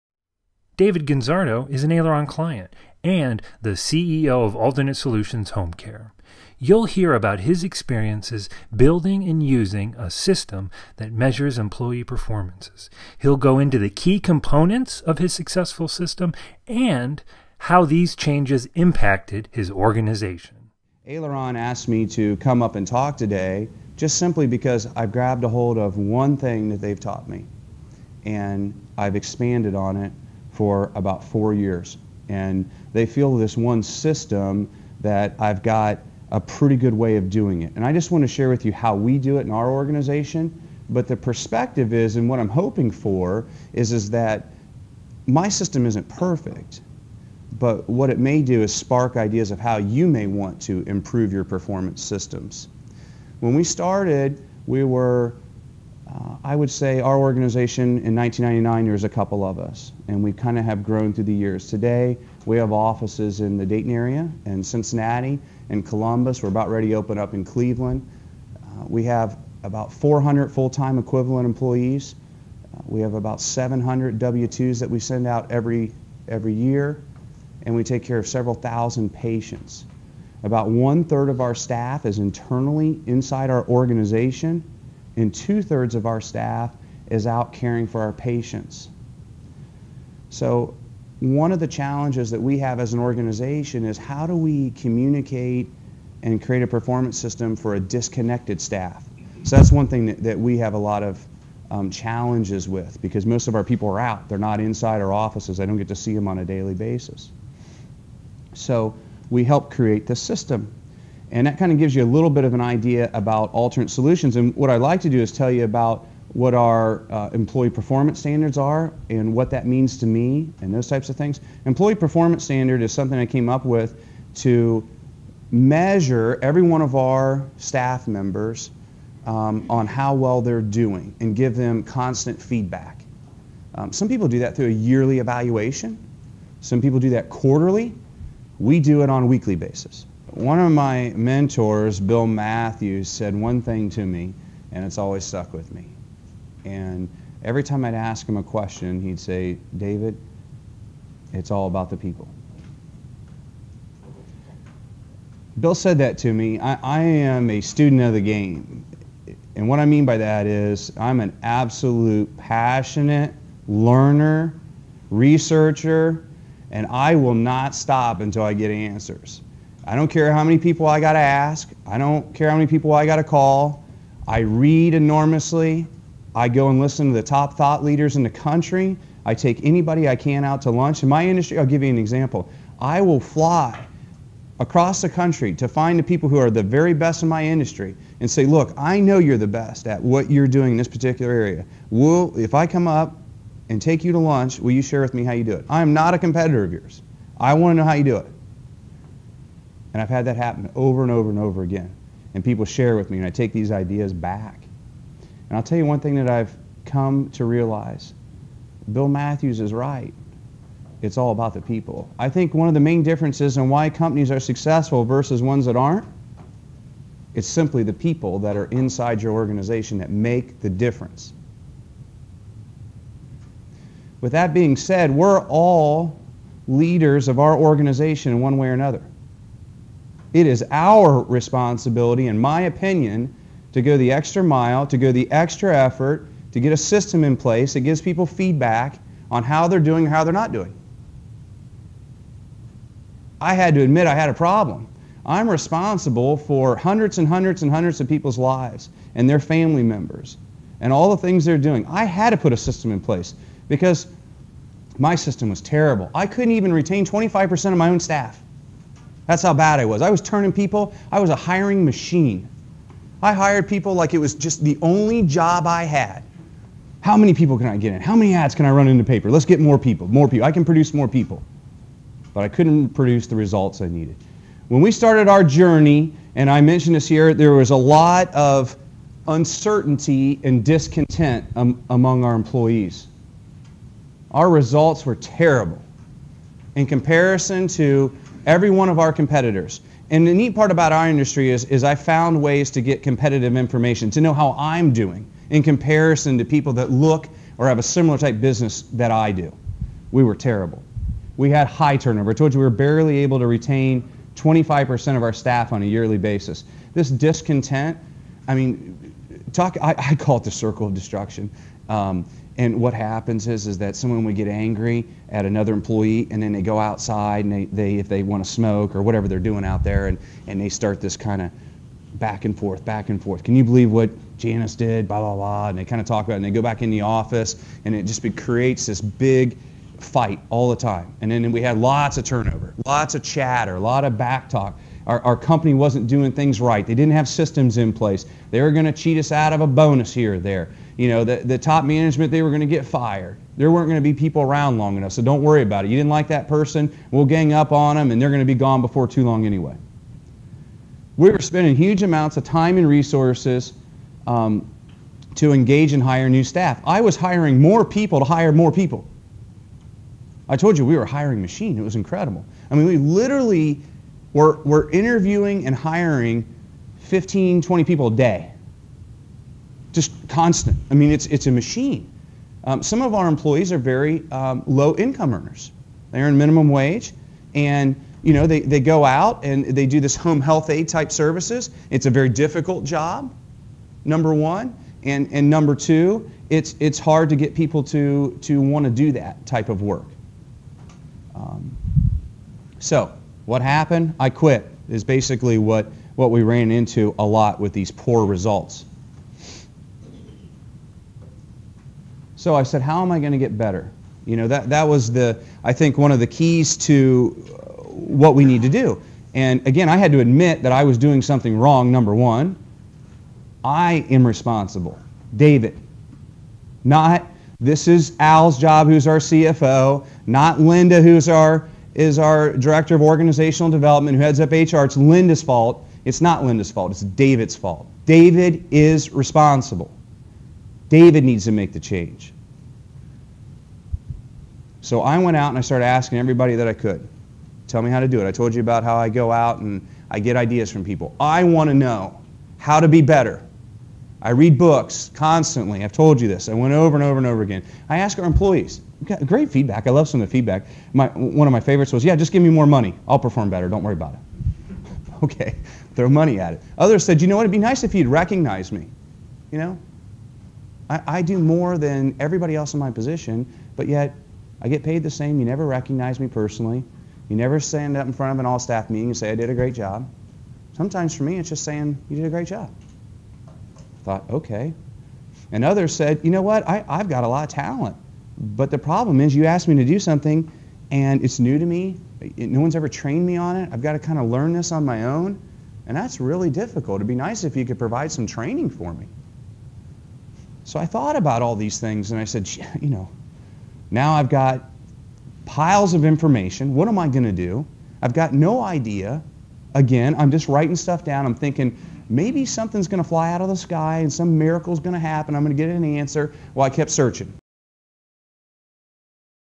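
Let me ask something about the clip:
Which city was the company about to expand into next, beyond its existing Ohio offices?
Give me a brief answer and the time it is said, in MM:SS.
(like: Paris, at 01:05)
Cleveland, at 01:07.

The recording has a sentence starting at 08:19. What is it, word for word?
Again, I'm just writing stuff down.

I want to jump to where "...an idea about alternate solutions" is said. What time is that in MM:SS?
01:52.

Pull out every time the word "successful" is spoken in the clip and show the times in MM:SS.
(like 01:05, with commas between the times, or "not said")
00:15, 03:34.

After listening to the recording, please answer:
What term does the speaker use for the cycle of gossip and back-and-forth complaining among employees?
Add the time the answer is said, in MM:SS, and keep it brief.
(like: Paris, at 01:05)
circle of destruction, at 05:10.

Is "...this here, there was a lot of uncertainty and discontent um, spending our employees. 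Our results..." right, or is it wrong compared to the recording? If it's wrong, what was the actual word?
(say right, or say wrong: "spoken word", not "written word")
wrong: "among", not "spending".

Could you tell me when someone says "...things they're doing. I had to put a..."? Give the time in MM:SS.
04:11.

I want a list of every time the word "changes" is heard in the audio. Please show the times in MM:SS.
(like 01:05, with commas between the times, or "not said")
00:18, 07:11.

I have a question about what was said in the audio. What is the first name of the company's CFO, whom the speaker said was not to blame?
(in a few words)
Al.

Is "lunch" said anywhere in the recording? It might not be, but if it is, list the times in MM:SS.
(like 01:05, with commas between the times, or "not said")
03:00, 03:14.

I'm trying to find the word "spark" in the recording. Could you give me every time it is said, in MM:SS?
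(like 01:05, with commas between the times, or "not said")
00:48.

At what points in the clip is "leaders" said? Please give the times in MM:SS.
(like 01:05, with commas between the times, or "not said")
02:57, 03:46.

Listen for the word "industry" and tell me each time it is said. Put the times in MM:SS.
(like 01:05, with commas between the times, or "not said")
03:01, 03:07, 04:51.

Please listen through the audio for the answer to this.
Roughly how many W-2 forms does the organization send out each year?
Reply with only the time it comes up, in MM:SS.
01:13.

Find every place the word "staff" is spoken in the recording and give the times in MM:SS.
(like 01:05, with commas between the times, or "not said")
01:21, 01:26, 01:38, 02:07, 04:17, 05:05, 05:56, 07:48.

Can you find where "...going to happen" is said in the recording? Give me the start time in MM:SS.
08:24.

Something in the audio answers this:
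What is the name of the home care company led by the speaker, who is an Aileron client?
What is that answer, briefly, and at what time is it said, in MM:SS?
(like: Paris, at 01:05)
Alternate Solutions Home Care, at 00:04.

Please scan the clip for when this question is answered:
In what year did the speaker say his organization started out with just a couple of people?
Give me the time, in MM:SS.
00:58.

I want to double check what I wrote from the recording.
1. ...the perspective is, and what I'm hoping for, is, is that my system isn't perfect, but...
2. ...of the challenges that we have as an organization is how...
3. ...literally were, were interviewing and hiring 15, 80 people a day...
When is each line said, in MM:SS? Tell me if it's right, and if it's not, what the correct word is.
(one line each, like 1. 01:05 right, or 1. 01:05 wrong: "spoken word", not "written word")
1. 00:41 right
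2. 01:31 right
3. 06:02 wrong: "20", not "80".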